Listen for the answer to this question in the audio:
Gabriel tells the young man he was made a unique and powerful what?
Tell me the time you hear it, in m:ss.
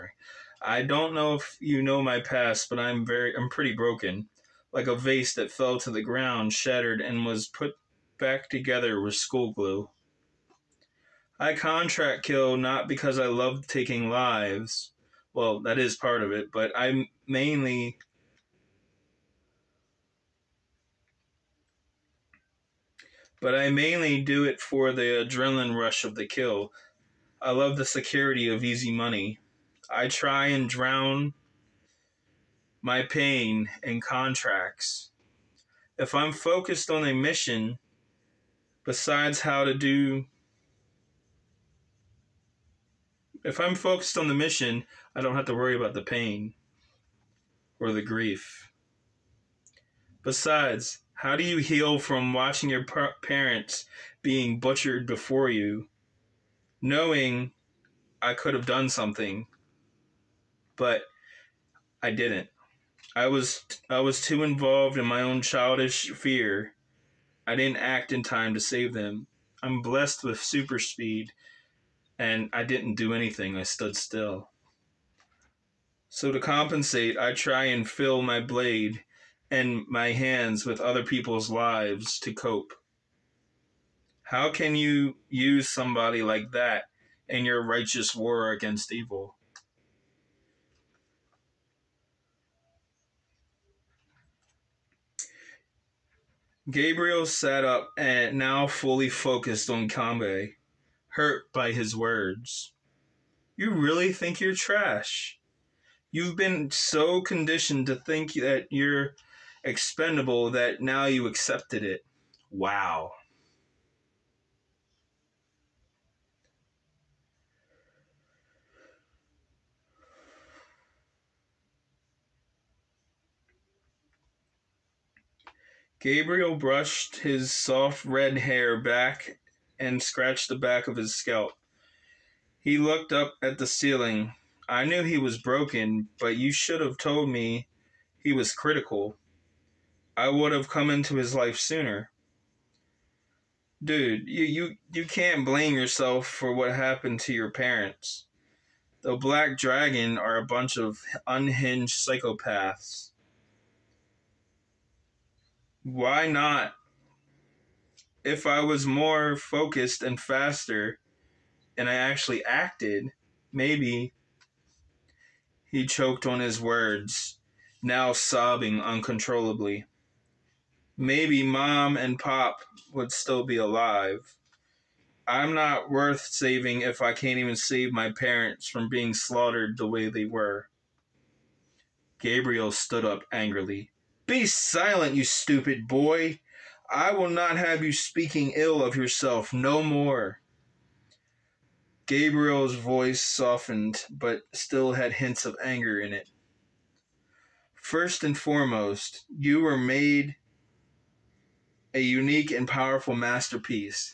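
3:23.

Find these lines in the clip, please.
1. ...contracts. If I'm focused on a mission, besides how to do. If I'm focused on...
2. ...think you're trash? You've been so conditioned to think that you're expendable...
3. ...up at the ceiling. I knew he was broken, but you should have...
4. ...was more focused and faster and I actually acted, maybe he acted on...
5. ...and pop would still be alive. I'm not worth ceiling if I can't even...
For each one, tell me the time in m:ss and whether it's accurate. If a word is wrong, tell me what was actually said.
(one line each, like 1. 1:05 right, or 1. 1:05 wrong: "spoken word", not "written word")
1. 0:34 right
2. 1:44 right
3. 2:13 right
4. 2:38 wrong: "choked", not "acted"
5. 2:51 wrong: "saving", not "ceiling".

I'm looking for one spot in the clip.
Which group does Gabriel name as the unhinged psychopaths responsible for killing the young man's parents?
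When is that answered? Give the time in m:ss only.
2:29.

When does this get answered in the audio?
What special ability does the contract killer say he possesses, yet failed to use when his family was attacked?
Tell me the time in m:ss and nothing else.
1:10.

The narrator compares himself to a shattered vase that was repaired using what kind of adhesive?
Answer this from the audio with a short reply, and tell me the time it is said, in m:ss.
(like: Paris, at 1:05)
school glue, at 0:09.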